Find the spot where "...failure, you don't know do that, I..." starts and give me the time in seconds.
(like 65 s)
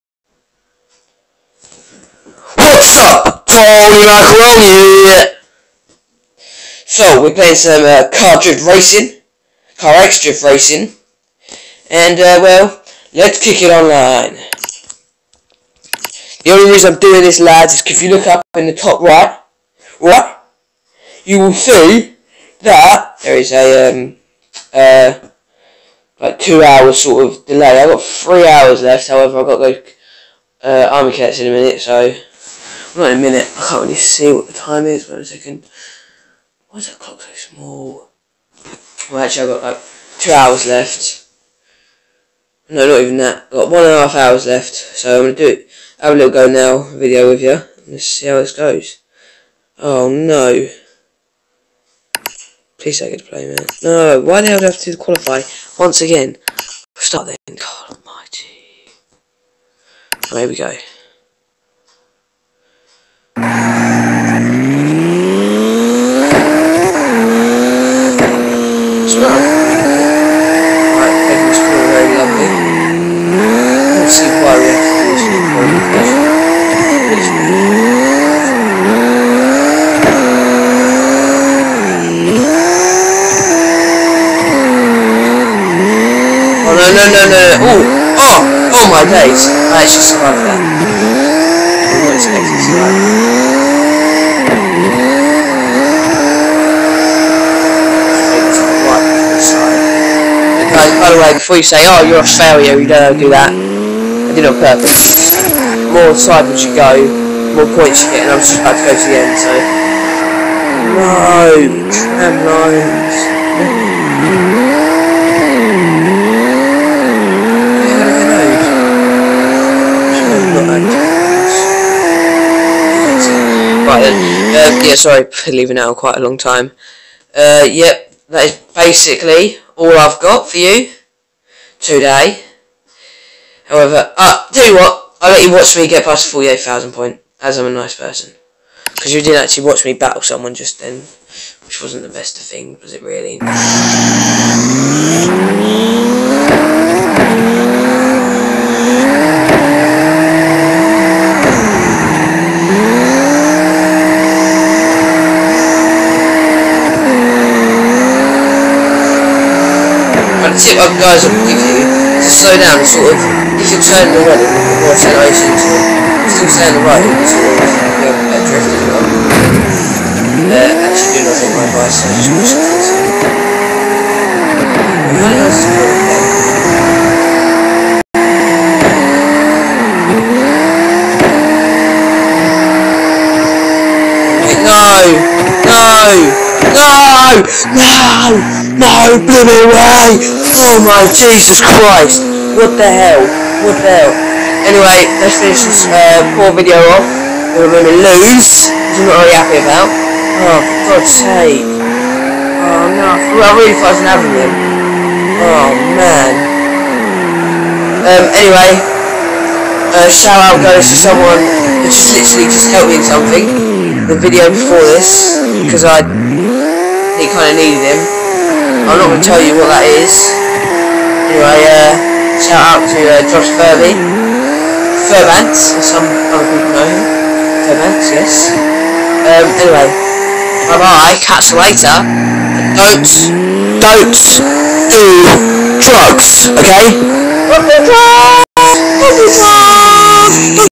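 102 s.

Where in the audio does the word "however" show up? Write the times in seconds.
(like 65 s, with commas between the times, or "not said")
29 s, 133 s.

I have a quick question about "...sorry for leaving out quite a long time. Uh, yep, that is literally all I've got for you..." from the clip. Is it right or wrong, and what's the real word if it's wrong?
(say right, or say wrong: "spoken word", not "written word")
wrong: "basically", not "literally".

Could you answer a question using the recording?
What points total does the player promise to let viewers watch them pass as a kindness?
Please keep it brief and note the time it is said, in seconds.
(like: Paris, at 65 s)
48,000, at 136 s.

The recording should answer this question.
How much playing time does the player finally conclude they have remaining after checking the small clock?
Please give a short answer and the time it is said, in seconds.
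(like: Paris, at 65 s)
1.5 hours, at 43 s.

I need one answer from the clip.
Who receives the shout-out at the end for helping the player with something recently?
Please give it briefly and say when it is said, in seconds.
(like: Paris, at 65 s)
Josh Furby, at 223 s.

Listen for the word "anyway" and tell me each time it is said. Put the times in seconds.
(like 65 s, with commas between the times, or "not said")
194 s, 208 s, 221 s, 229 s.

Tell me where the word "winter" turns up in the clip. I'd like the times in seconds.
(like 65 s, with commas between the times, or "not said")
not said.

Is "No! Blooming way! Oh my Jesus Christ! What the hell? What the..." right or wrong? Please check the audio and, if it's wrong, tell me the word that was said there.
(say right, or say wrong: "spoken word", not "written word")
right.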